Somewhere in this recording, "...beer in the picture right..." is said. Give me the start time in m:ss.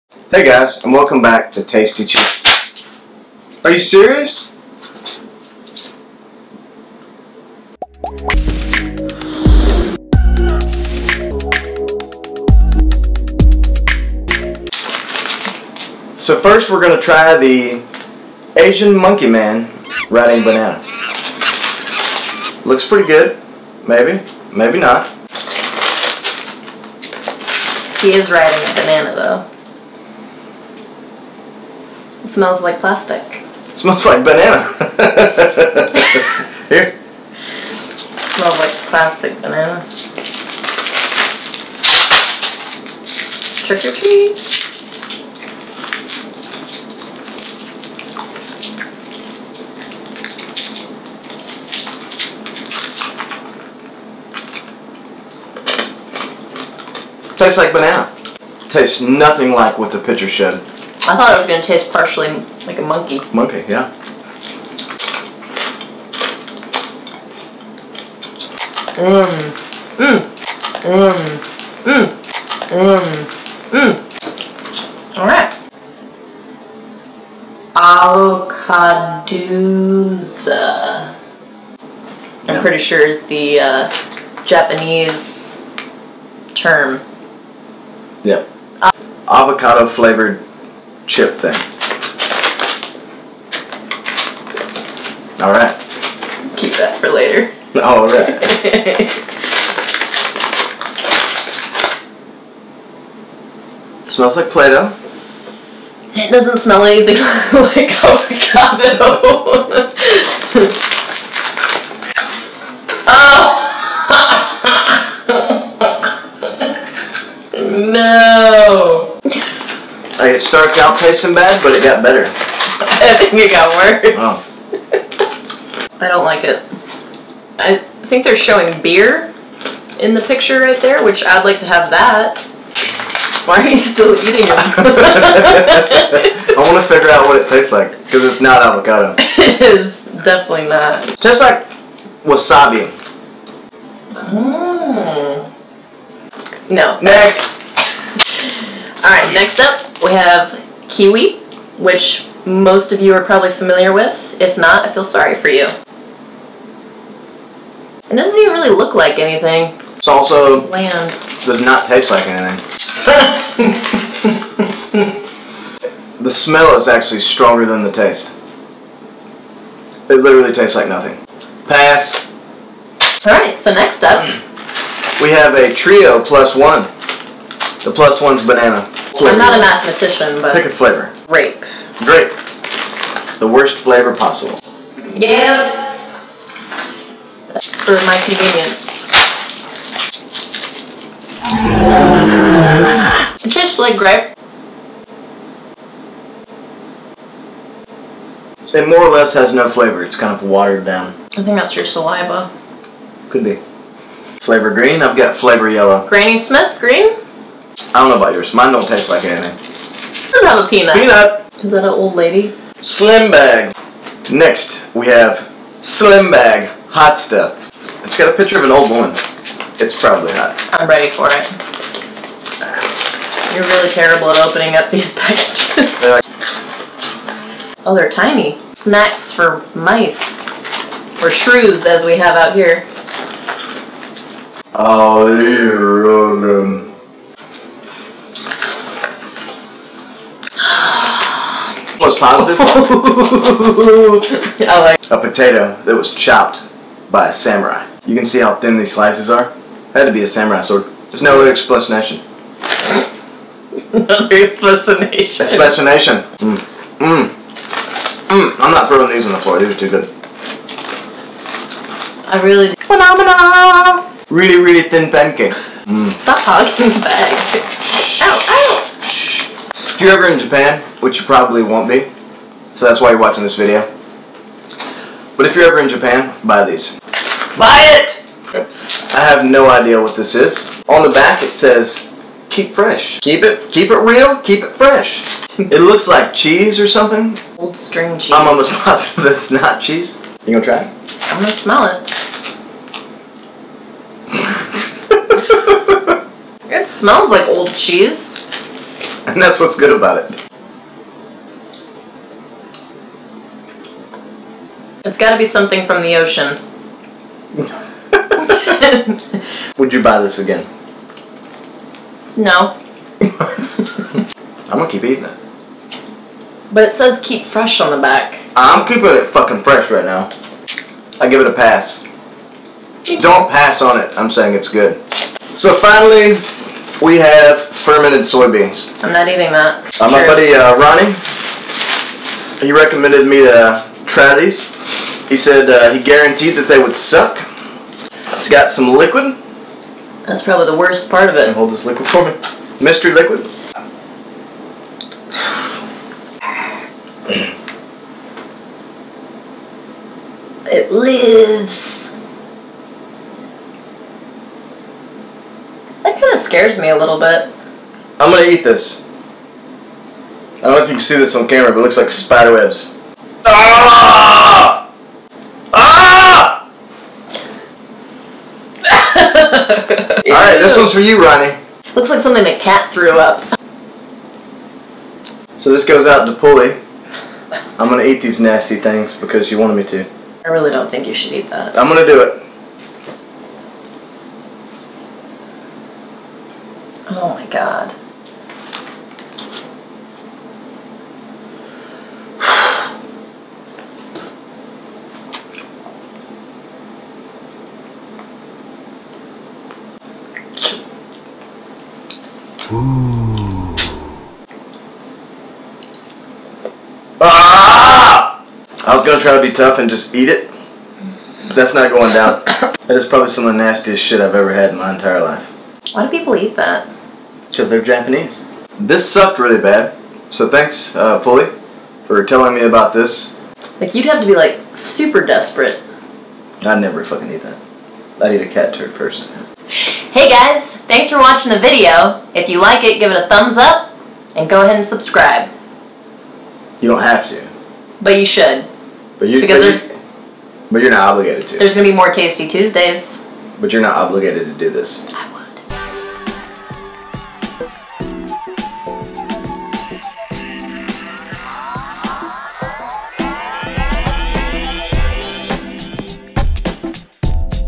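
2:08.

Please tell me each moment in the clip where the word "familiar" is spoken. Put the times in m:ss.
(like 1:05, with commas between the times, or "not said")
2:33.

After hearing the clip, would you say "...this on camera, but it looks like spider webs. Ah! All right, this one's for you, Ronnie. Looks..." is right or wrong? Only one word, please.
right.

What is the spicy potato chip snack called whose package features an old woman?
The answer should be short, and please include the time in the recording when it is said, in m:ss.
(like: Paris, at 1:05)
Slim bag hot stuff, at 3:35.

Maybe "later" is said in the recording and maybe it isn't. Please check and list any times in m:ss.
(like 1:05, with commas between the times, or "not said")
1:37.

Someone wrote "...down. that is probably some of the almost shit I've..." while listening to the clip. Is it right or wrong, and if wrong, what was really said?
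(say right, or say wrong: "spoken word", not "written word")
wrong: "nastiest", not "almost".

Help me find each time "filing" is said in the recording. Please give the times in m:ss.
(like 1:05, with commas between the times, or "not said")
not said.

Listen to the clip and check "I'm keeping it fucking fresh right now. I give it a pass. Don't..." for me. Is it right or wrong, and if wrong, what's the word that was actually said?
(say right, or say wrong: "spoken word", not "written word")
right.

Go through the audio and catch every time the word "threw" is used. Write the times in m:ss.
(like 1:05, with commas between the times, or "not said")
6:12.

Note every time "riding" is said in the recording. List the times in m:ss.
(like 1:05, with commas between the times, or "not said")
0:20, 0:28.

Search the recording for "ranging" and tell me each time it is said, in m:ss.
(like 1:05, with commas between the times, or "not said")
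not said.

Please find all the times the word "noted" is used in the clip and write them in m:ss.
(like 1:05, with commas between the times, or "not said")
not said.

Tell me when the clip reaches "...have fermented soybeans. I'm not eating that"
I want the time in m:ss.
5:27.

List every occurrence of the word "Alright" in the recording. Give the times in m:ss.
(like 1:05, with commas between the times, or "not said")
1:15, 2:53.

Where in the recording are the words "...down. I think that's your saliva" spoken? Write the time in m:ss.
3:20.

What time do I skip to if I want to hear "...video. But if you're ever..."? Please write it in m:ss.
4:33.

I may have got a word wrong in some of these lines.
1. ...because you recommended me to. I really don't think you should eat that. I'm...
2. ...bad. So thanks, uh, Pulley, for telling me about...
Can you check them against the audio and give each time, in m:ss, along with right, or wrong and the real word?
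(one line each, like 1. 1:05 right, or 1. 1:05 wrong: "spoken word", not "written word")
1. 6:19 wrong: "wanted", not "recommended"
2. 6:59 right.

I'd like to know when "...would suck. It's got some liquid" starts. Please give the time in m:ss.
5:36.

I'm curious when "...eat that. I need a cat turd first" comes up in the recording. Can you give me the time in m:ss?
7:07.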